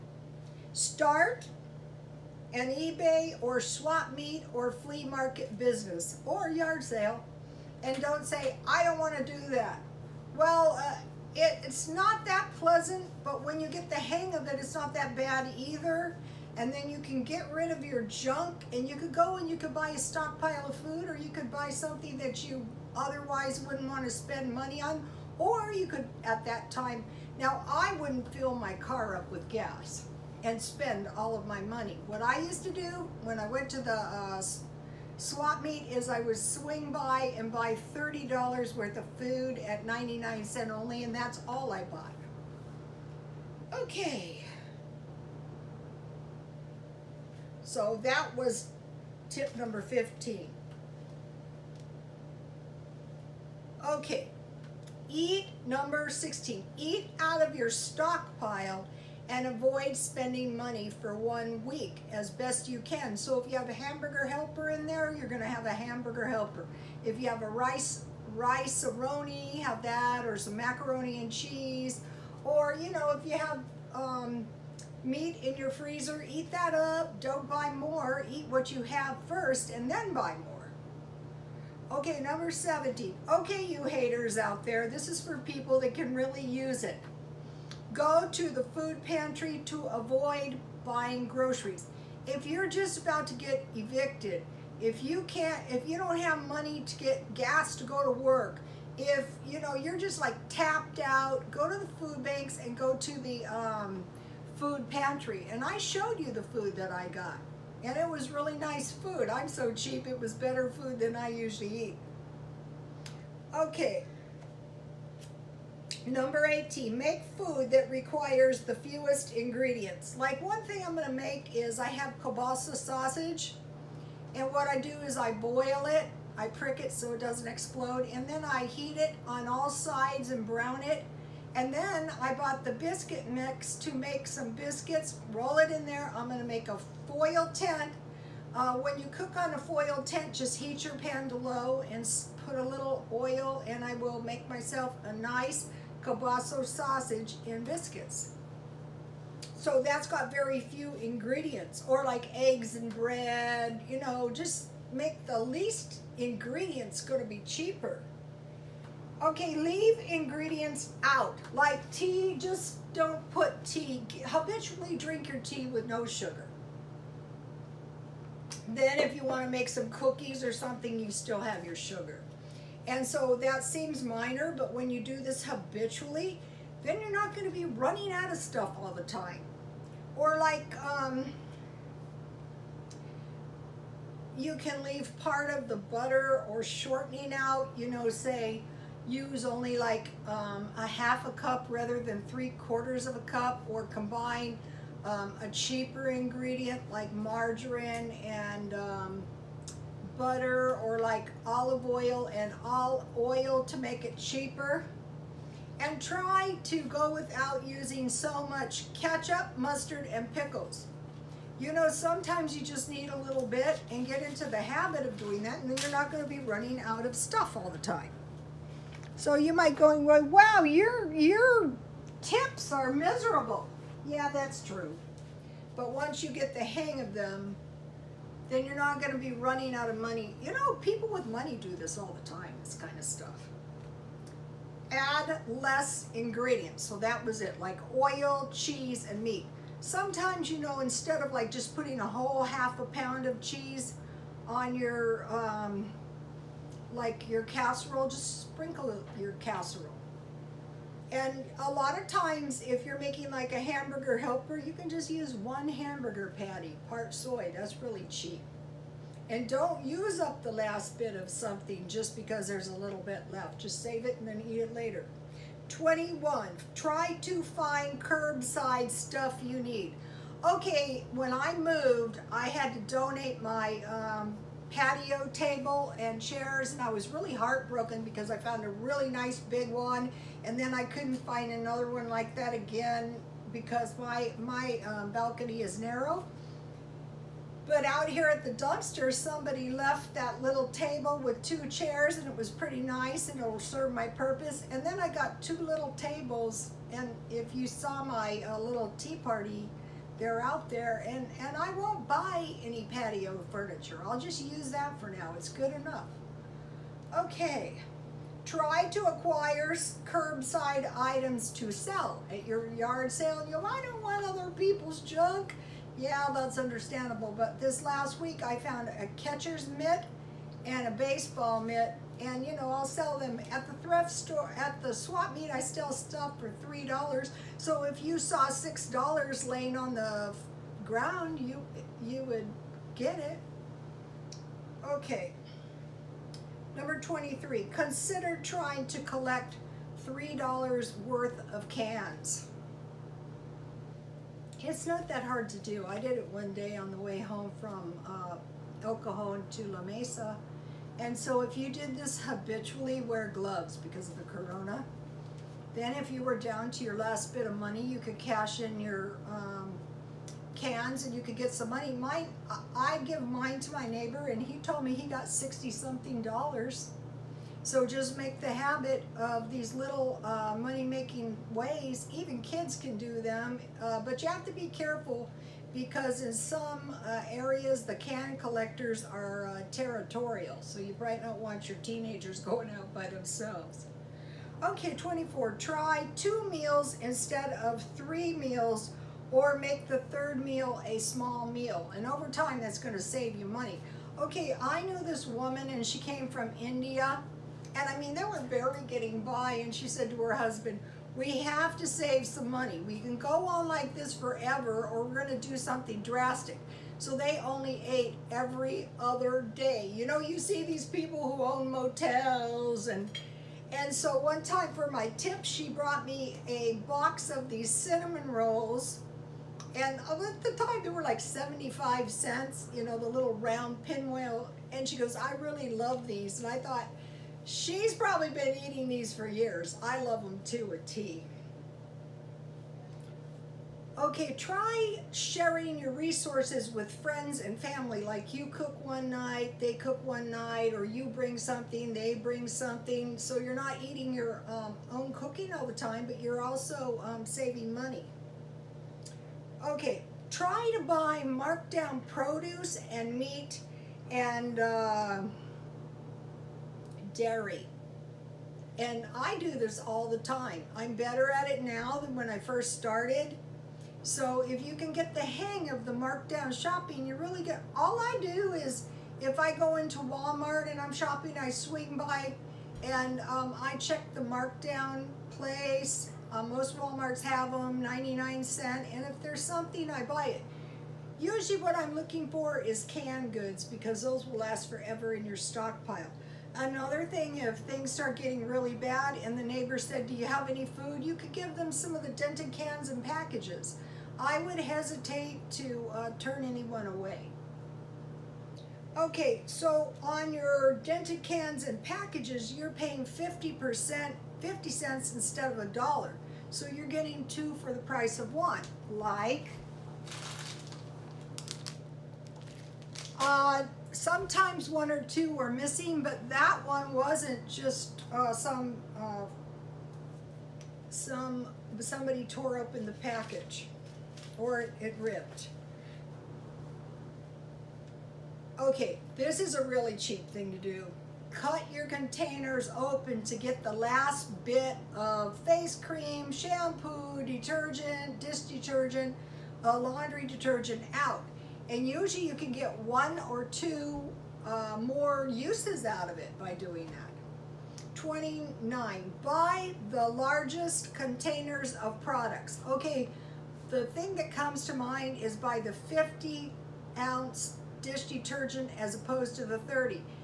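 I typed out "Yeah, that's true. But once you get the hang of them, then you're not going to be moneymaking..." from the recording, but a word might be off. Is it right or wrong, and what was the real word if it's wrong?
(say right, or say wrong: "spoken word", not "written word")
wrong: "running", not "moneymaking".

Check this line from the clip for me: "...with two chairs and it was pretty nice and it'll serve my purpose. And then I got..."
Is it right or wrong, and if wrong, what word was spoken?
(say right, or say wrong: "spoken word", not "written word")
right.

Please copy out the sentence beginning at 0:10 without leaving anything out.
Well, uh, it, it's not that pleasant, but when you get the hang of it, it's not that bad either.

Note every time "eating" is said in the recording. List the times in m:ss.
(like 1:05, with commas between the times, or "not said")
7:08, 7:23.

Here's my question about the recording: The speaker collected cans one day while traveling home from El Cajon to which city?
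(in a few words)
La Mesa.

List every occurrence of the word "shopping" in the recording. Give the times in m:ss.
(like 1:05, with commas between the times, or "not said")
7:46, 7:50.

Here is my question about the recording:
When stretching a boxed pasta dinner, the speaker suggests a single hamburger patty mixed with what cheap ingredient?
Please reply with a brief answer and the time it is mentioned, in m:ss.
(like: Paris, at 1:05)
soy, at 4:17.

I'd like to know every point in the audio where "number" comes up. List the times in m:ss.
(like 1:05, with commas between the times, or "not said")
0:49, 0:55, 1:22, 1:56, 5:36.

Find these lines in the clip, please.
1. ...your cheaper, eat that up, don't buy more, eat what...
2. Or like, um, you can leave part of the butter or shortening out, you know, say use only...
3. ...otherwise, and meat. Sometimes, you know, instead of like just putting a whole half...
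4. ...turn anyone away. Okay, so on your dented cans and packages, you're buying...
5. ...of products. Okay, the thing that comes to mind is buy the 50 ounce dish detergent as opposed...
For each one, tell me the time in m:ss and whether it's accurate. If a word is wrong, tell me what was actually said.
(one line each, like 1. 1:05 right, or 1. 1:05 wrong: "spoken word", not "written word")
1. 1:15 wrong: "freezer", not "cheaper"
2. 3:00 right
3. 3:58 wrong: "cheese", not "otherwise"
4. 8:16 wrong: "paying", not "buying"
5. 9:11 right.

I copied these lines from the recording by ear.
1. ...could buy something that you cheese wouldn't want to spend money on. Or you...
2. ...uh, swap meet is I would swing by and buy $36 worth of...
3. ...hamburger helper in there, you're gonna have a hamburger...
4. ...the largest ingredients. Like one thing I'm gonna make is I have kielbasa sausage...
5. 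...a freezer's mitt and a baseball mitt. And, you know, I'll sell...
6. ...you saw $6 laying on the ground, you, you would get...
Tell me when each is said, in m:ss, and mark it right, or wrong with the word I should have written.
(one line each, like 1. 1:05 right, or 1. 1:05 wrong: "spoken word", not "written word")
1. 0:21 wrong: "otherwise", not "cheese"
2. 0:33 wrong: "30", not "36"
3. 1:03 right
4. 1:58 wrong: "fewest", not "largest"
5. 5:18 wrong: "catcher", not "freezer"
6. 5:28 right.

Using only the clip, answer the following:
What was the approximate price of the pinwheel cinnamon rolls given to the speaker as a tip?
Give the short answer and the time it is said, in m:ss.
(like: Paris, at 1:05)
75 cents, at 7:01.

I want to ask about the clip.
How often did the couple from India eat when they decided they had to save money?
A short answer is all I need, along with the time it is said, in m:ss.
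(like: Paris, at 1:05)
every other day, at 6:48.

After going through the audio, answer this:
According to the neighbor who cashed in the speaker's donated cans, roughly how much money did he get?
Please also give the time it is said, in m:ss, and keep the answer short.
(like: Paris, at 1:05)
$60 something, at 6:05.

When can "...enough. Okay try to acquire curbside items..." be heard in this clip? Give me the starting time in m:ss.
5:05.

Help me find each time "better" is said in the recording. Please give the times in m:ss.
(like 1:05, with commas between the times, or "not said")
1:50, 7:40.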